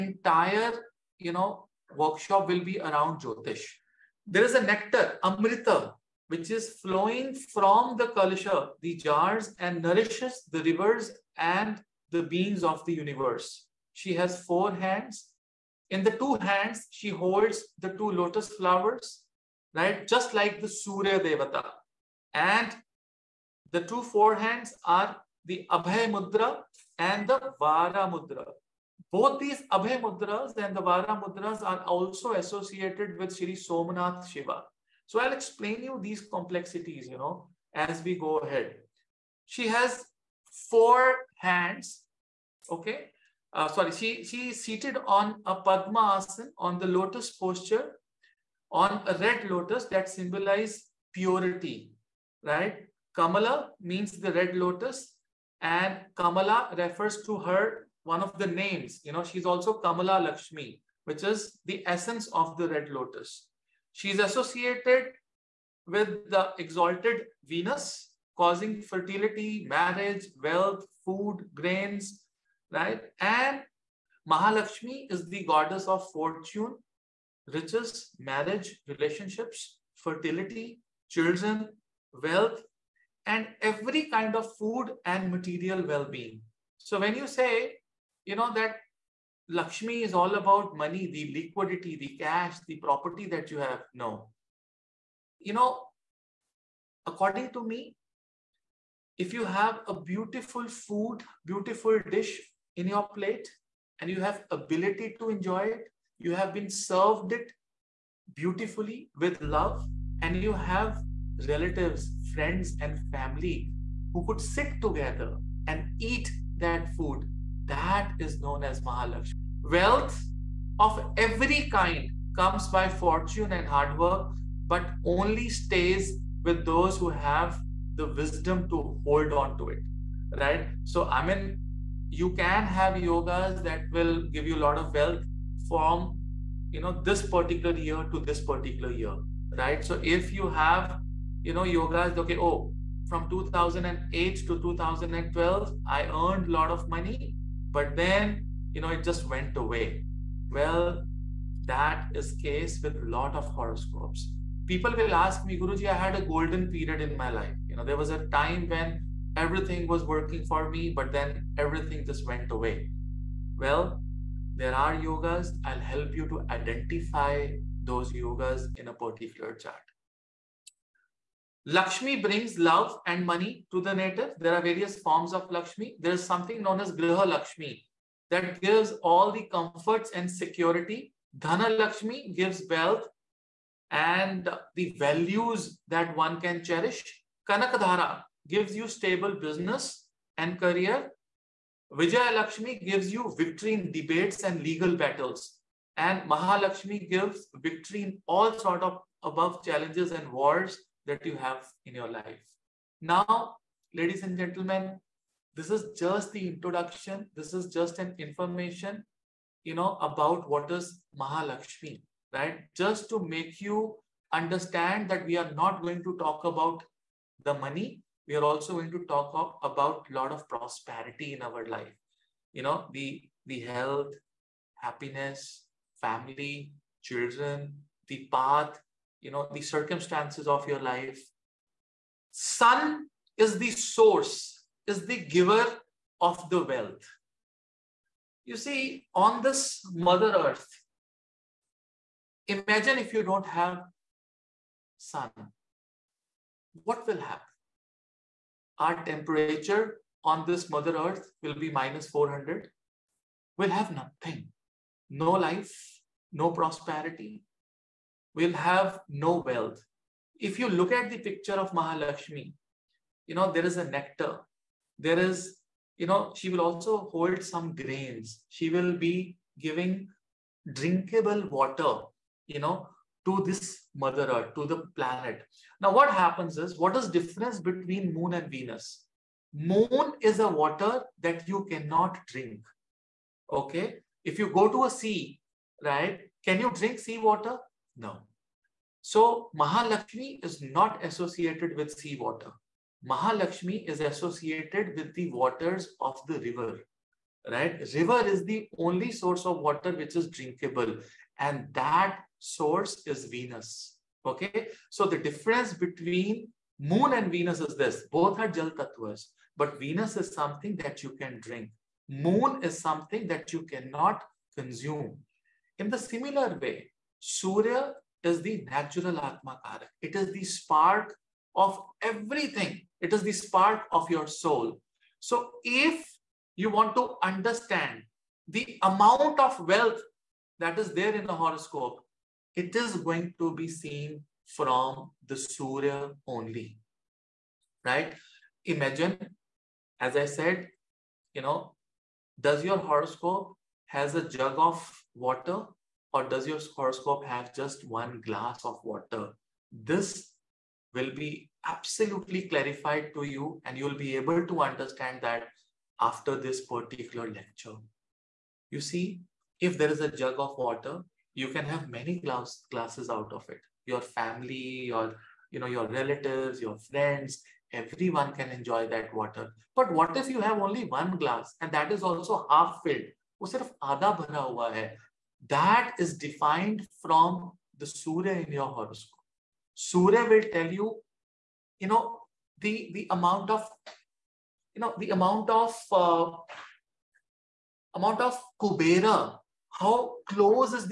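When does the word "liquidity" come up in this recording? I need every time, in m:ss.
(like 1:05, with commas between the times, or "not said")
1:31.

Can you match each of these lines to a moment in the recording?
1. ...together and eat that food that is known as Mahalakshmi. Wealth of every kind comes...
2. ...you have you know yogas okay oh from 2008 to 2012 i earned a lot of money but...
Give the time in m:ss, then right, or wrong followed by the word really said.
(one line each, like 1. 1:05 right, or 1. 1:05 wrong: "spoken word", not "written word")
1. 1:54 right
2. 2:20 right.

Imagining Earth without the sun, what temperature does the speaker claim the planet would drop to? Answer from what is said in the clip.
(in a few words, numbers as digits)
minus 400.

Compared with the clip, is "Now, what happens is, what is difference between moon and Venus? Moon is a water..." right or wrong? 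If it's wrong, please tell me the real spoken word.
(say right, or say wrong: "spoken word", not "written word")
right.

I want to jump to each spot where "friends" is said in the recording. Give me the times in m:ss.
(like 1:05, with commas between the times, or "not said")
1:52, 6:06.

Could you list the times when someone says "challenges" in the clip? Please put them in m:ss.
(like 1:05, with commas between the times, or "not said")
3:19.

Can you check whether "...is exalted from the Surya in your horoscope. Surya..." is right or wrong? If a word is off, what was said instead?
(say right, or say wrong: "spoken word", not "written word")
wrong: "defined", not "exalted".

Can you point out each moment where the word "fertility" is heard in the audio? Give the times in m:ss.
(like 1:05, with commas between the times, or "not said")
1:08, 1:19.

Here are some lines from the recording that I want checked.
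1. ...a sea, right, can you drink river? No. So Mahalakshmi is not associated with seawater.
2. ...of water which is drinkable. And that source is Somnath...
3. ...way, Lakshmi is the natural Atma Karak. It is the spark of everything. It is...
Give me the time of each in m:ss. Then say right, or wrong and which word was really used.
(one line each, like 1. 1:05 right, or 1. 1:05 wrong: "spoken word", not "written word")
1. 4:44 wrong: "seawater", not "river"
2. 4:59 wrong: "Venus", not "Somnath"
3. 5:16 wrong: "Surya", not "Lakshmi".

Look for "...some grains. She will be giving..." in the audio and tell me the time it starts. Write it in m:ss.
4:27.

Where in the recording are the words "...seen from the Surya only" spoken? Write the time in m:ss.
5:33.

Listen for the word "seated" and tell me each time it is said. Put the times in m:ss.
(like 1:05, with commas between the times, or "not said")
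0:44.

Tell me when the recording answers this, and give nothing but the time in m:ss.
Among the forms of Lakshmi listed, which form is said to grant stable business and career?
3:07.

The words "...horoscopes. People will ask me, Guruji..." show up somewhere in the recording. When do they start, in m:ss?
2:33.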